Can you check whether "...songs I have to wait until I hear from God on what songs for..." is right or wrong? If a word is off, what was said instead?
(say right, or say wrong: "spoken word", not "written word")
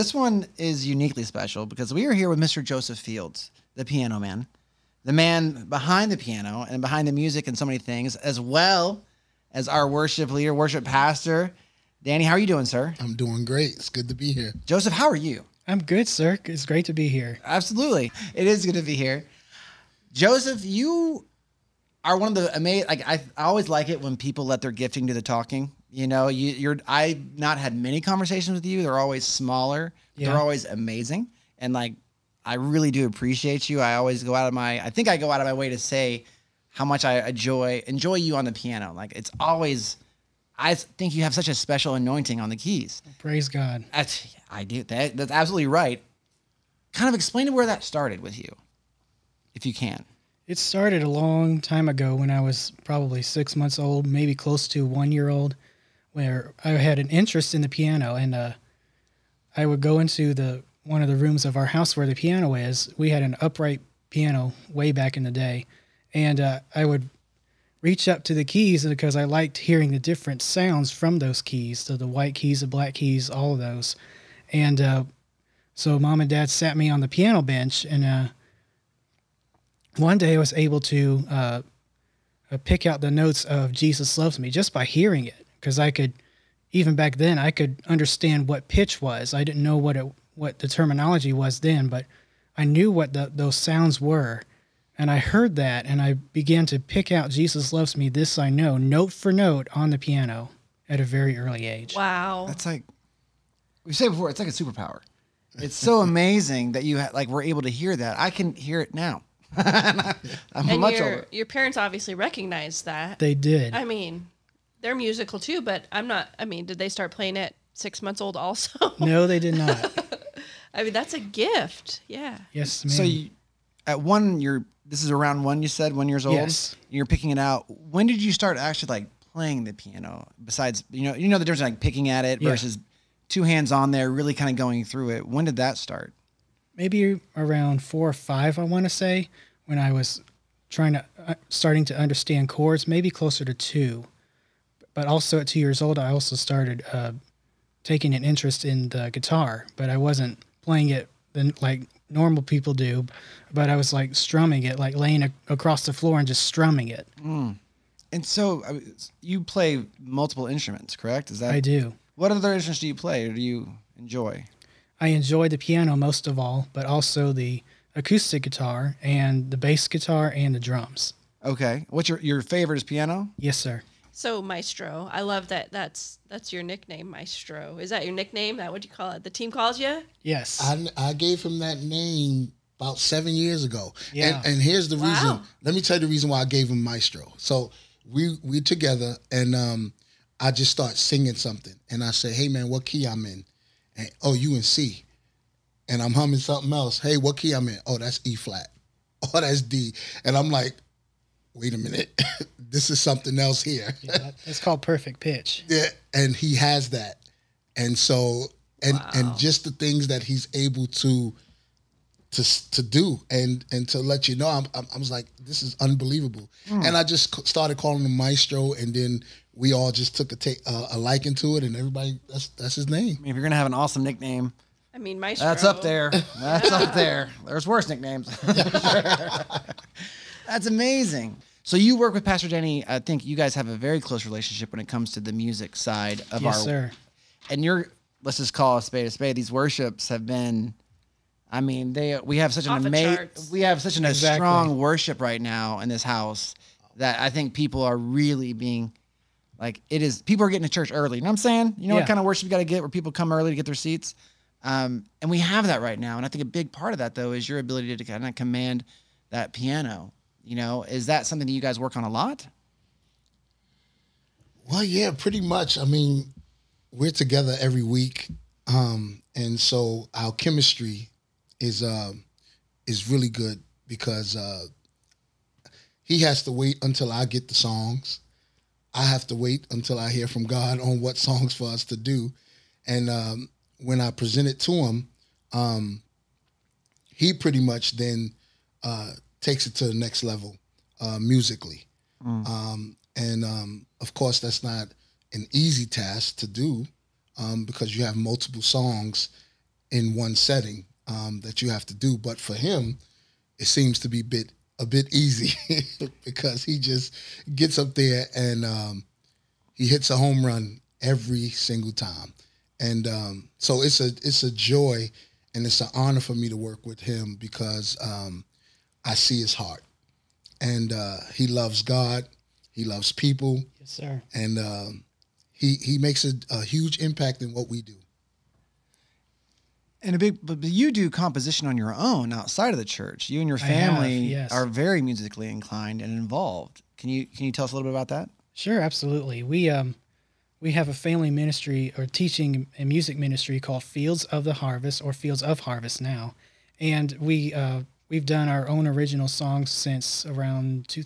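right.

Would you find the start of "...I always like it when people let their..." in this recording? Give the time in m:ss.
0:23.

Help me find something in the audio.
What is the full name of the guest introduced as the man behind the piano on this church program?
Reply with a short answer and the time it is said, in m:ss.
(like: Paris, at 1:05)
Joseph Fields, at 0:02.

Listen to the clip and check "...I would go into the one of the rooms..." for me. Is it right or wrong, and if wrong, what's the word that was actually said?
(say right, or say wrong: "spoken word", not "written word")
right.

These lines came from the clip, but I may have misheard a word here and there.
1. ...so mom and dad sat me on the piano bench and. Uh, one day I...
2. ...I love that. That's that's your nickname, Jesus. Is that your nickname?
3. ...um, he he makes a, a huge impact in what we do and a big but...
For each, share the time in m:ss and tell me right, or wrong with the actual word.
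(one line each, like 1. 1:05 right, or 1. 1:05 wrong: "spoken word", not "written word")
1. 1:15 right
2. 2:55 wrong: "Maestro", not "Jesus"
3. 5:24 right.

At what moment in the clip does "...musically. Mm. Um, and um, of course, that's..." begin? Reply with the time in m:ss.
4:51.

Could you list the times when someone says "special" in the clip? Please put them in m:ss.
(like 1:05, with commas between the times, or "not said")
0:01, 0:41.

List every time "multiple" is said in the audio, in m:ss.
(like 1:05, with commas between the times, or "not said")
2:39, 4:58.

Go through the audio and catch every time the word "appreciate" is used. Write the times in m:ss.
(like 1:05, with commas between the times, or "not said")
0:33.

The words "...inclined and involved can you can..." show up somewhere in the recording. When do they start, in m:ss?
5:35.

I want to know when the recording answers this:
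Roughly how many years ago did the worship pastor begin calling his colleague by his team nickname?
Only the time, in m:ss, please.
3:02.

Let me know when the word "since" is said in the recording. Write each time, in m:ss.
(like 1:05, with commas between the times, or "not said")
5:49.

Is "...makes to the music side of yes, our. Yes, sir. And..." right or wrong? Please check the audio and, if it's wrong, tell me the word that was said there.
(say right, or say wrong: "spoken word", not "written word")
wrong: "comes", not "makes".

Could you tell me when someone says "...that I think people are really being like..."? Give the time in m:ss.
4:06.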